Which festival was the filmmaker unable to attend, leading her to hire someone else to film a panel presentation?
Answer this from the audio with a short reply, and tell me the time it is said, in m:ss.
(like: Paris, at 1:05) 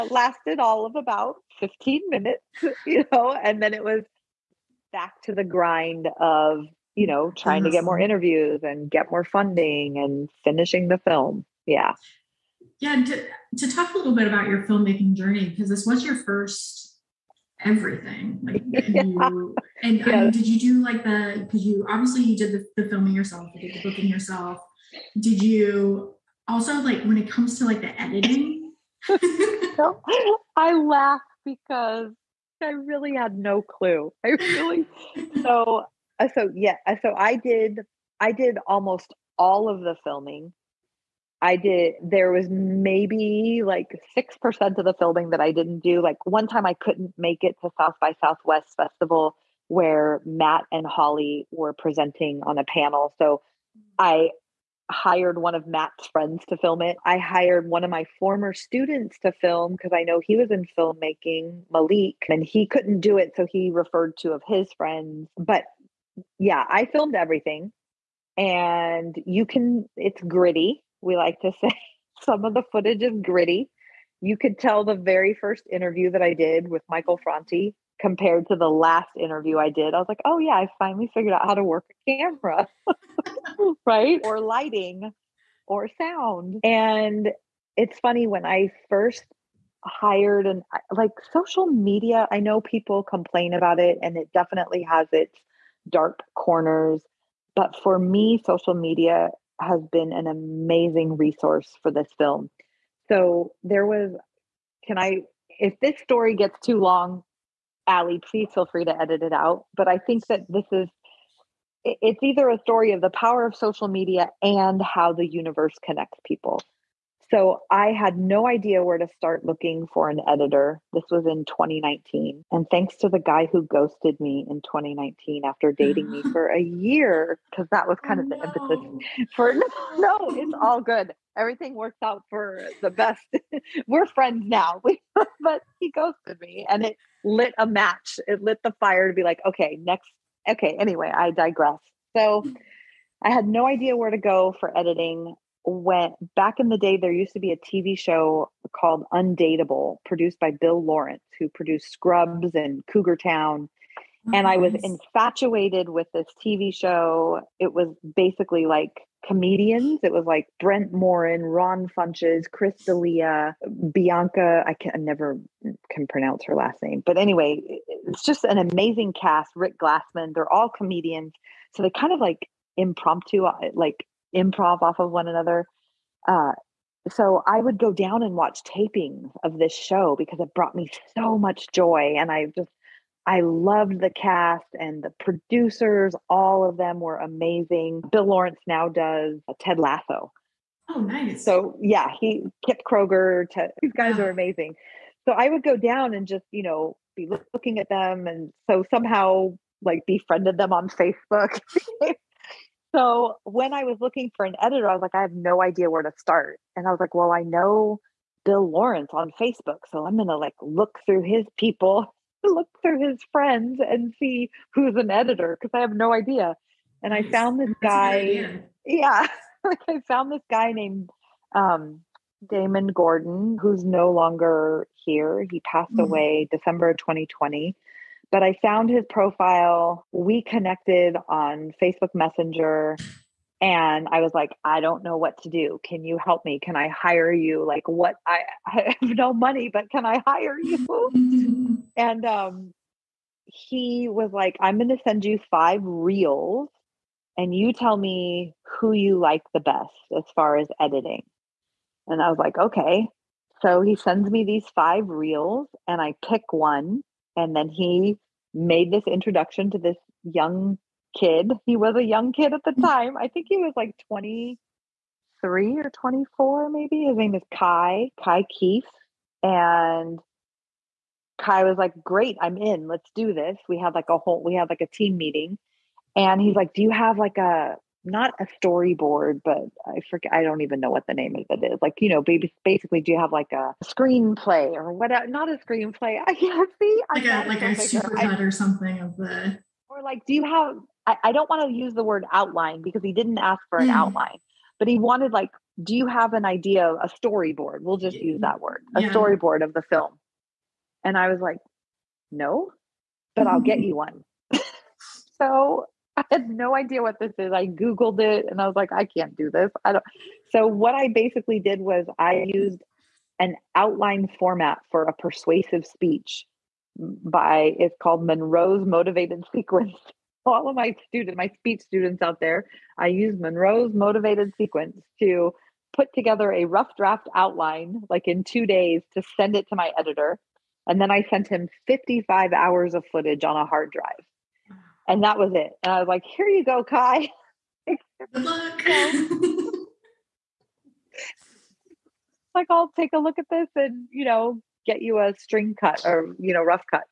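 South by Southwest, at 0:47.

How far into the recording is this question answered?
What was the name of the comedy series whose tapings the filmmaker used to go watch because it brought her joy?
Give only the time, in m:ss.
2:29.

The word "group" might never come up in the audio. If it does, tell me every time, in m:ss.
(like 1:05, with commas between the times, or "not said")
not said.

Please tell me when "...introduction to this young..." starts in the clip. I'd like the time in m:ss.
4:19.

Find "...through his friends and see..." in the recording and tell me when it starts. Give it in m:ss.
3:32.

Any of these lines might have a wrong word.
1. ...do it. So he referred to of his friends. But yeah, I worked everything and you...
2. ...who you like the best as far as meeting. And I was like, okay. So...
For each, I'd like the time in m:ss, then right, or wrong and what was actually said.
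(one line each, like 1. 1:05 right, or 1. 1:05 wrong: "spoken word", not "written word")
1. 1:03 wrong: "filmed", not "worked"
2. 4:08 wrong: "editing", not "meeting".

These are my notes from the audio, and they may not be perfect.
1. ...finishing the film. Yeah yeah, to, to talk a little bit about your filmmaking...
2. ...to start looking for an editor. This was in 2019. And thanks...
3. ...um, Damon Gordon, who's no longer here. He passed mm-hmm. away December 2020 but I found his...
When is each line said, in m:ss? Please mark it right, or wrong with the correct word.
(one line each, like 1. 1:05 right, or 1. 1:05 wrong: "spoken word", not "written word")
1. 0:10 right
2. 1:58 right
3. 3:41 right.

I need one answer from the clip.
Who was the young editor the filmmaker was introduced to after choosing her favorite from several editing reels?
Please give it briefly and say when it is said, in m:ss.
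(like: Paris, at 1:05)
Kai Keefe, at 4:28.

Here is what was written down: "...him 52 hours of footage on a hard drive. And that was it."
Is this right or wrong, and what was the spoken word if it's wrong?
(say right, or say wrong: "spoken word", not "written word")
wrong: "55", not "52".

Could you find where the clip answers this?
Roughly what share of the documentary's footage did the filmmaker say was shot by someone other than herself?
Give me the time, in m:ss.
0:44.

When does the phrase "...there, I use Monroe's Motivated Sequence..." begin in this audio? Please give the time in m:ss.
5:22.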